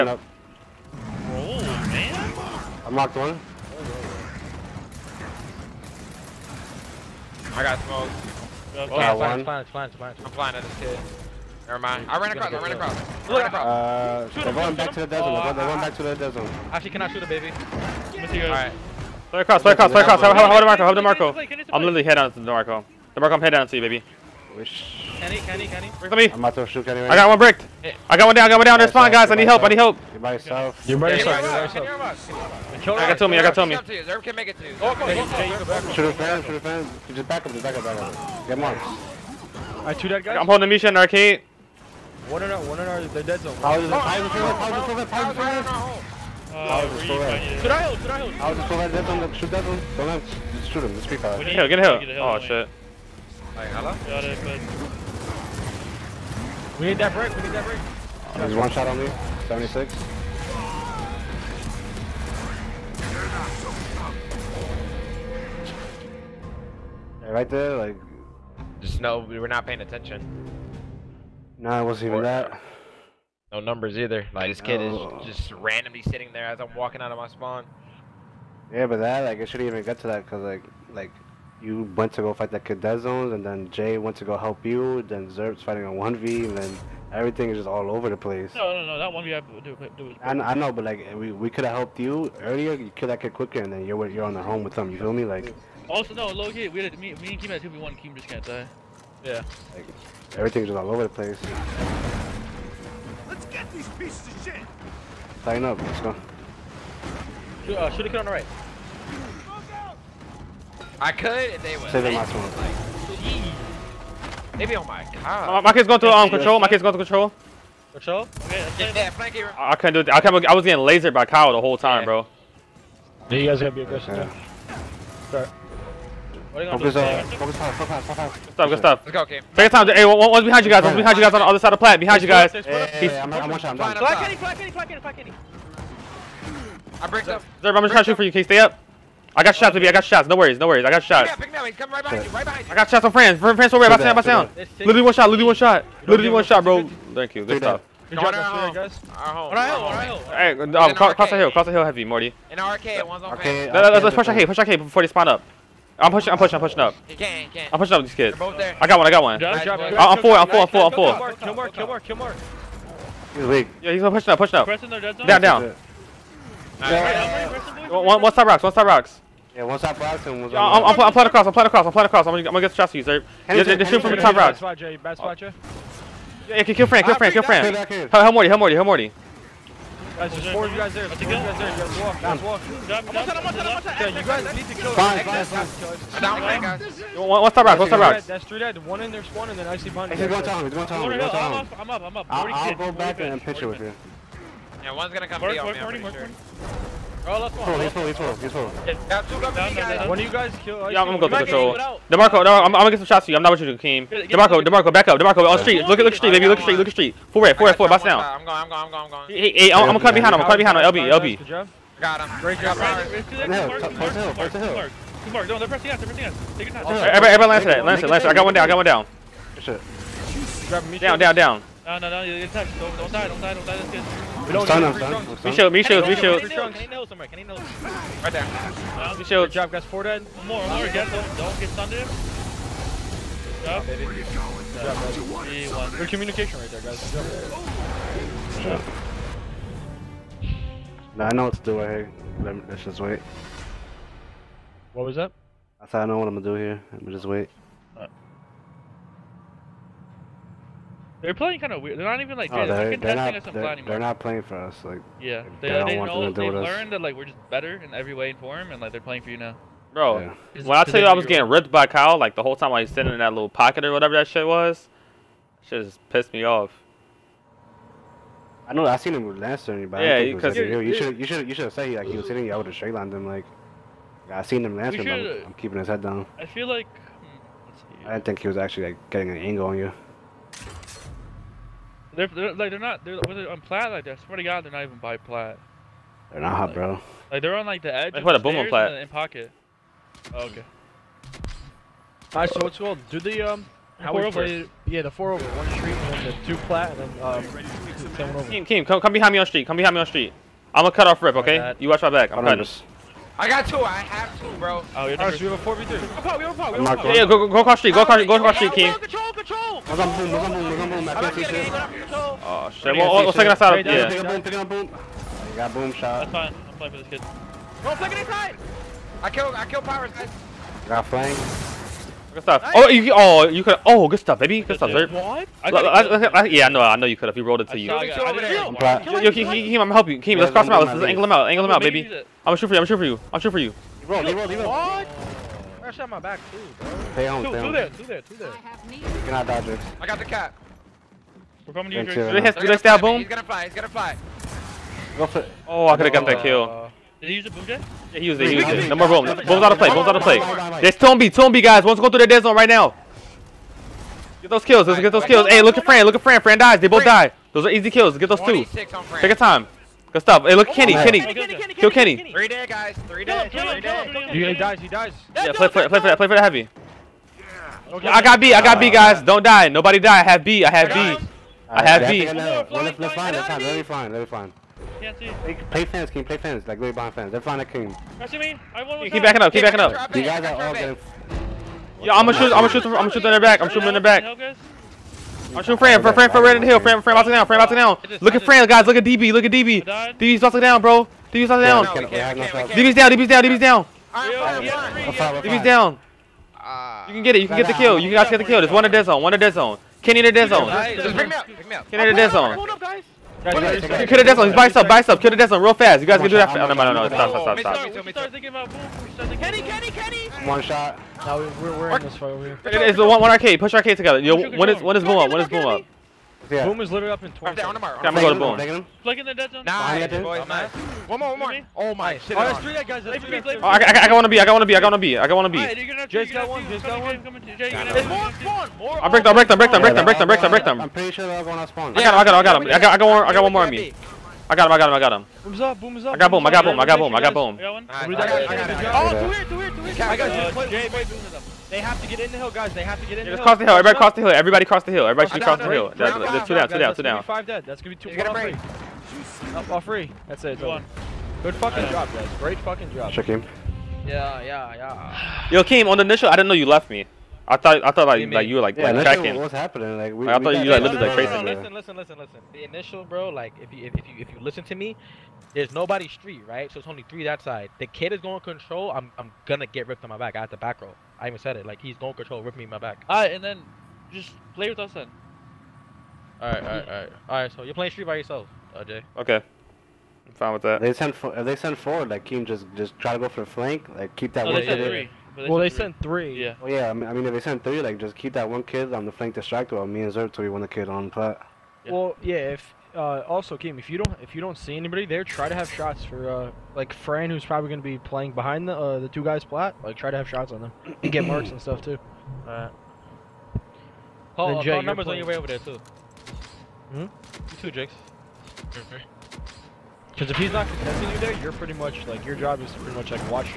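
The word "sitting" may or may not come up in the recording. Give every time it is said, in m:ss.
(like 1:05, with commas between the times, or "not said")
1:16, 4:22, 4:32.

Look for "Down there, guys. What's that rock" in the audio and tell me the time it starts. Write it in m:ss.
3:06.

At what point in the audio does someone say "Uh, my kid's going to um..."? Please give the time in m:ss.
1:55.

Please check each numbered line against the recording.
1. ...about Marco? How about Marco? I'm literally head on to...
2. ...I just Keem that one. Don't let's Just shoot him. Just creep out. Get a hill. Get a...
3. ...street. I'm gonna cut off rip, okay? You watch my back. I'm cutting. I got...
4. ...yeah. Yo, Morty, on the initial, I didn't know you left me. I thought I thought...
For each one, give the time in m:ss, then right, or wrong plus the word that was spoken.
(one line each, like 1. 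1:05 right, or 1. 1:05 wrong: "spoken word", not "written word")
1. 0:20 right
2. 0:48 wrong: "Shoot", not "Keem"
3. 5:00 right
4. 7:34 wrong: "Kim", not "Morty".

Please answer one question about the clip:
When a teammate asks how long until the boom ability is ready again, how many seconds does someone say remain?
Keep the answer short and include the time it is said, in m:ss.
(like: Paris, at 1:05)
20, at 6:56.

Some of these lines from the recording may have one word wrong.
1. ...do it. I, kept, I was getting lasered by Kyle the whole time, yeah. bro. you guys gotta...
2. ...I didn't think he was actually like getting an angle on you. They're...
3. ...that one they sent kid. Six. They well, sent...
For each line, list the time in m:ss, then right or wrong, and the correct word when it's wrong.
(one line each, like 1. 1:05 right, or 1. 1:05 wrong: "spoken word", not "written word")
1. 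1:59 right
2. 4:38 right
3. 8:04 wrong: "Three", not "Six".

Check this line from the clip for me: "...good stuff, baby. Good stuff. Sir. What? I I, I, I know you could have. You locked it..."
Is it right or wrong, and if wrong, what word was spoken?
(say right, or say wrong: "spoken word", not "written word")
wrong: "rolled", not "locked".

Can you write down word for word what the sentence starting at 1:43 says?
Let's get these pieces of shit.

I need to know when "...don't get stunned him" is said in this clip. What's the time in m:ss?
3:51.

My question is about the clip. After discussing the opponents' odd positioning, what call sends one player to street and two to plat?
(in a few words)
four over.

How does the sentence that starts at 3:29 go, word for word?
Hey, hey, I'm gonna cut behind him.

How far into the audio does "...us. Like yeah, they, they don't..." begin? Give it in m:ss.
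4:14.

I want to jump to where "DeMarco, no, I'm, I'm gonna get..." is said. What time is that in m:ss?
3:22.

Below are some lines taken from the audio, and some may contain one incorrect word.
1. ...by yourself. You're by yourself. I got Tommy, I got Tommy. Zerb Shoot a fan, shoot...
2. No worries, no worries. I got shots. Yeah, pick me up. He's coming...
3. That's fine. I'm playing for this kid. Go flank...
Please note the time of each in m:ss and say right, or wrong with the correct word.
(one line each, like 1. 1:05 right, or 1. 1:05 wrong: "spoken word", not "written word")
1. 0:30 right
2. 2:20 right
3. 5:16 right.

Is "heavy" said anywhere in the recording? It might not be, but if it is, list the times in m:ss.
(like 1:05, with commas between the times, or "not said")
2:31, 6:06.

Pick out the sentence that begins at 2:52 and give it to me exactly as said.
I'm gonna, I'm gonna get stressed you, sir.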